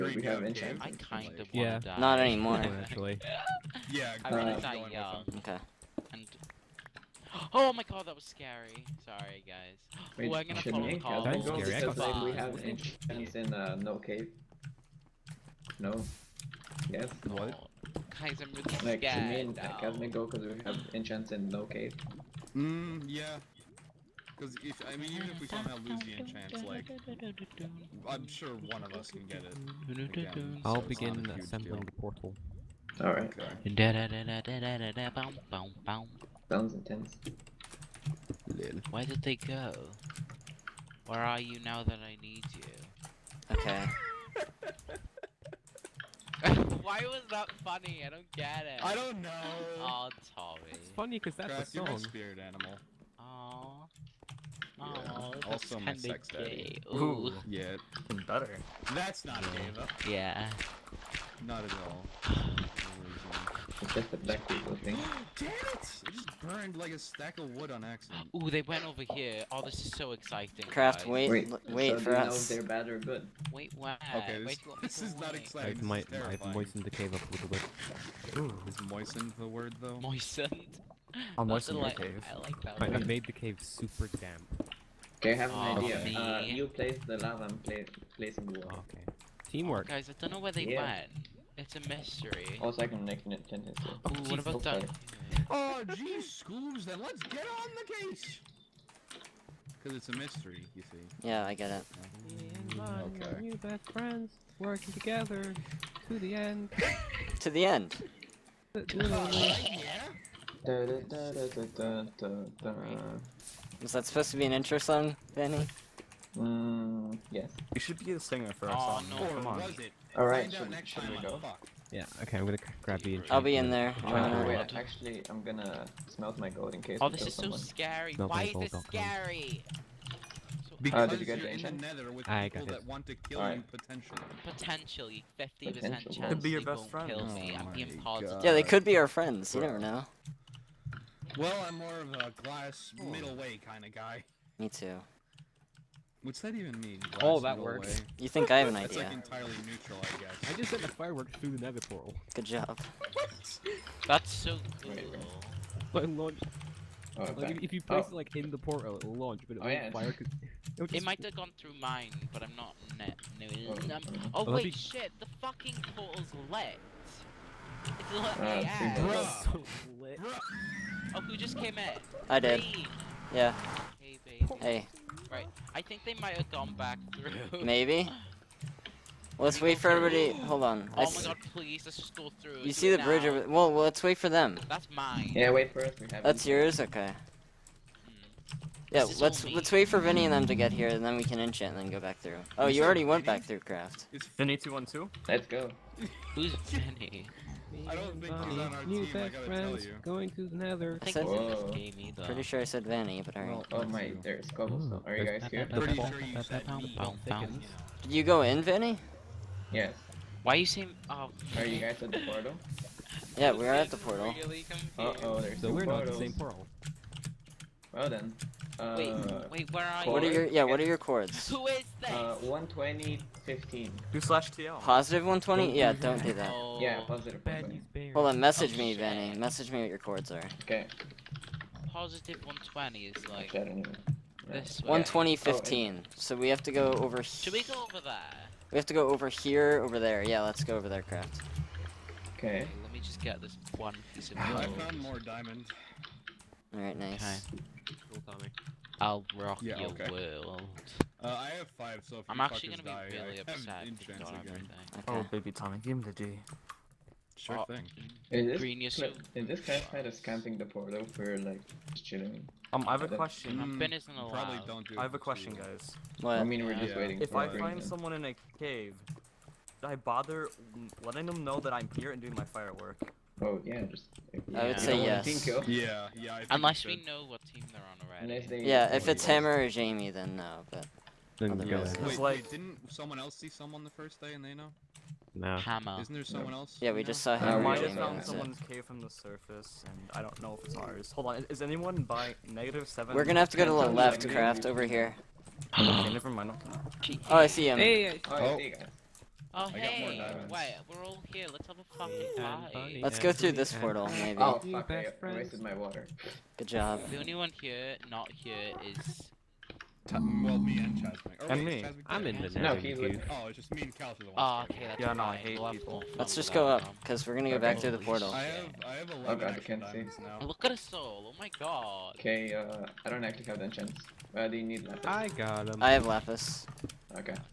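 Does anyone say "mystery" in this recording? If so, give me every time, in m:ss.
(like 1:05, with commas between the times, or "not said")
1:31, 1:40.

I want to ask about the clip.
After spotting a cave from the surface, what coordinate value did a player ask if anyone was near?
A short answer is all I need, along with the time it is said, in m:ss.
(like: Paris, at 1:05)
negative seven, at 4:52.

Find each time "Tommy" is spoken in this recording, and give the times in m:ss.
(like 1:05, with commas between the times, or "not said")
0:50, 4:08, 4:15.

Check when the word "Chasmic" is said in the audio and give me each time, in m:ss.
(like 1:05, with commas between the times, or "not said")
5:10.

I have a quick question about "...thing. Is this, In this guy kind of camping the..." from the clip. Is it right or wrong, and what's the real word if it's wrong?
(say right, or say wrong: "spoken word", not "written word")
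right.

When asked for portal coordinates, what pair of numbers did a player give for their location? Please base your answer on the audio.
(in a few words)
120, 15.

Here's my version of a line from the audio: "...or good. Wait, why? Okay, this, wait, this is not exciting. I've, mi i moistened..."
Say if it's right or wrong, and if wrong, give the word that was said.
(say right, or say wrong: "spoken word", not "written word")
right.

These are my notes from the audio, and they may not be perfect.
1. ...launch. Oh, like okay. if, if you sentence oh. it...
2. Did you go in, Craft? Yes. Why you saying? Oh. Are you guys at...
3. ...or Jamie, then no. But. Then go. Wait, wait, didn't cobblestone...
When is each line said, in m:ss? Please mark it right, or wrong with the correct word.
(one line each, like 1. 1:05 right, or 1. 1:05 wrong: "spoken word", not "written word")
1. 2:36 wrong: "place", not "sentence"
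2. 3:28 wrong: "Vanny", not "Craft"
3. 4:39 wrong: "someone", not "cobblestone".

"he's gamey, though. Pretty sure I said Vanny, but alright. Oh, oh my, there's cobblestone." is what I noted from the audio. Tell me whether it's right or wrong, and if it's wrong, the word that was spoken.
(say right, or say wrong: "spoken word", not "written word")
right.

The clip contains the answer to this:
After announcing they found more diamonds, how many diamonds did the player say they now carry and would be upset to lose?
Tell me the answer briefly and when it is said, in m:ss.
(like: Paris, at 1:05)
5, at 4:11.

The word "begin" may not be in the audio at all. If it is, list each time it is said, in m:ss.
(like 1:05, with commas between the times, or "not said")
0:30.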